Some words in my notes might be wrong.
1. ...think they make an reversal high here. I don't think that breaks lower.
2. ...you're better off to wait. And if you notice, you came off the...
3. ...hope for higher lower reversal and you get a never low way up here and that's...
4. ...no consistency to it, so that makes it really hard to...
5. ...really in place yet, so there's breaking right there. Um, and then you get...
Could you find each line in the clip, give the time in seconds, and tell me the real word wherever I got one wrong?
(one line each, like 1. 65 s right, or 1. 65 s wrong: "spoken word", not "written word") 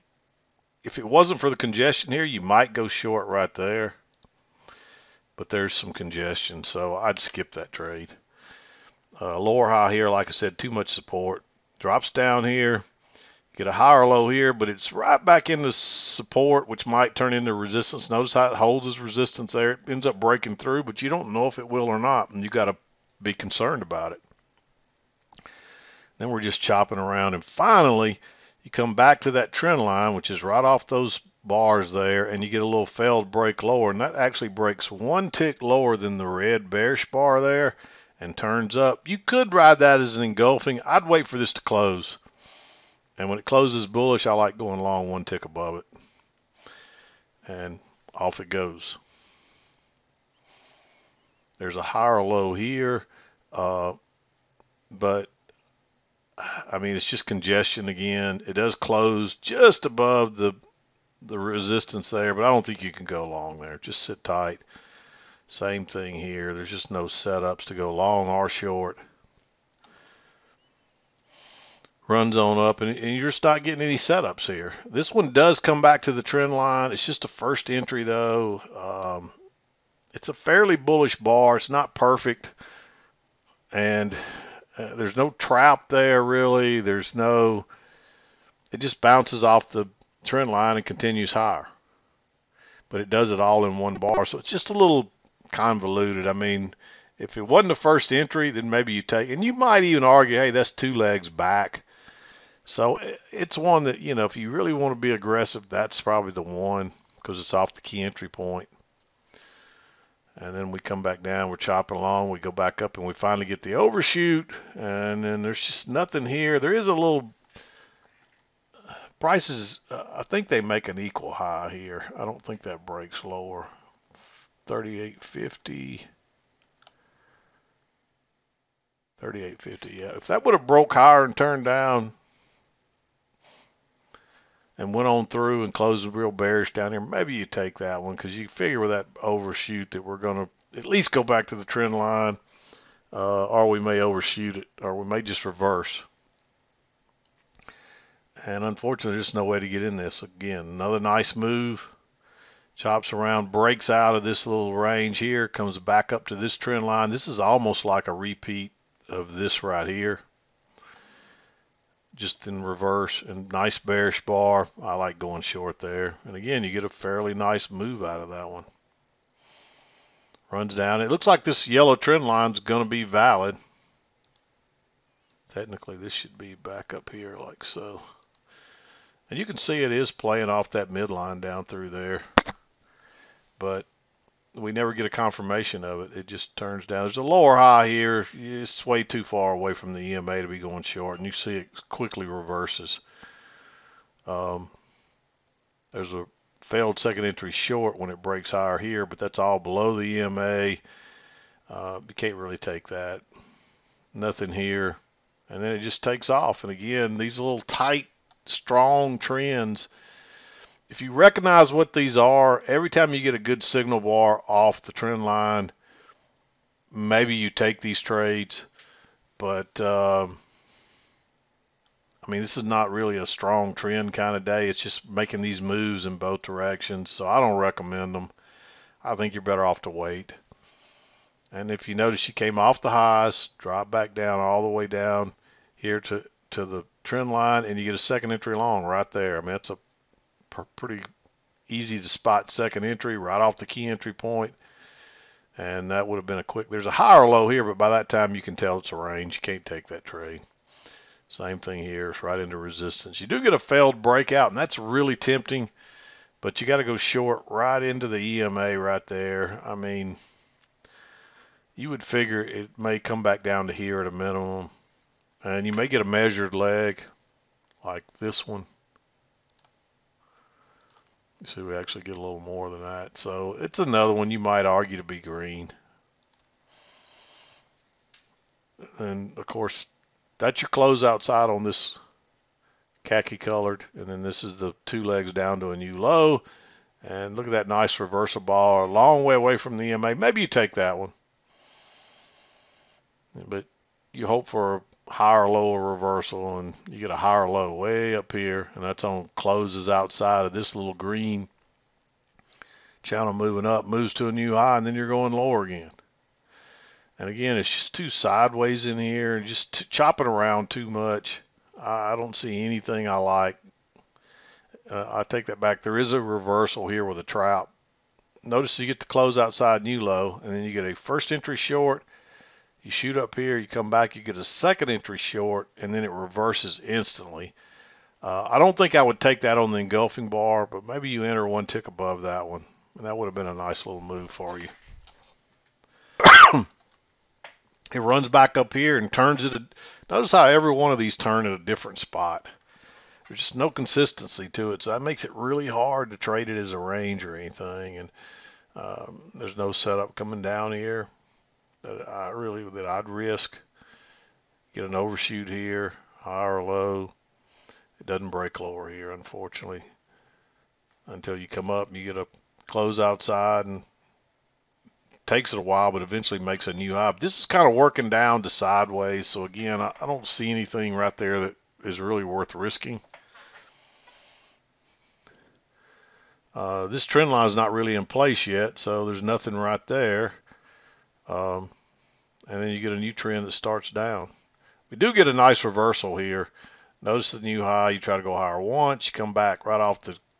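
1. 120 s wrong: "equal", not "reversal"
2. 229 s right
3. 294 s wrong: "higher", not "never"
4. 343 s right
5. 377 s wrong: "nothing", not "breaking".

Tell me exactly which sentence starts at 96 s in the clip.
I mean, if it wasn't the first entry, then maybe you take, and you might even argue, hey, that's two legs back.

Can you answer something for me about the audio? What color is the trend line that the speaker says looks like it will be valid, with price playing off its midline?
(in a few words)
Yellow.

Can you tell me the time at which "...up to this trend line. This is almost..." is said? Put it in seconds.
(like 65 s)
156 s.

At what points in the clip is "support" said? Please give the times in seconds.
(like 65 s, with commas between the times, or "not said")
10 s, 15 s.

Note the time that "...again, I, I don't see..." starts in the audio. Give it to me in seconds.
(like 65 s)
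369 s.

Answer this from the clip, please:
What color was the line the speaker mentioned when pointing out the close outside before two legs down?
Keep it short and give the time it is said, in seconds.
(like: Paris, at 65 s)
Khaki, at 283 s.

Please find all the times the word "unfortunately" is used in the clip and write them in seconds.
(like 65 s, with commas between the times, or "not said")
148 s, 359 s.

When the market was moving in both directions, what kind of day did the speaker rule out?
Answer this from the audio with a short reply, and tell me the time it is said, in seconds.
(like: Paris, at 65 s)
Strong trend, at 223 s.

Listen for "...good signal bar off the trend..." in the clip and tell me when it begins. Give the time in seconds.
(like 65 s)
213 s.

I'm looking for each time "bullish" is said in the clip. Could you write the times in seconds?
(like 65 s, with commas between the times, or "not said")
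43 s, 80 s.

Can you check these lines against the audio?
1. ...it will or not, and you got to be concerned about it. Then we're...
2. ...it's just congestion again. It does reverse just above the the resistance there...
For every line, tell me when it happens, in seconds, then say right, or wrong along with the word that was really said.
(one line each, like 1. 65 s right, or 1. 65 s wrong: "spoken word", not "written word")
1. 21 s right
2. 56 s wrong: "close", not "reverse".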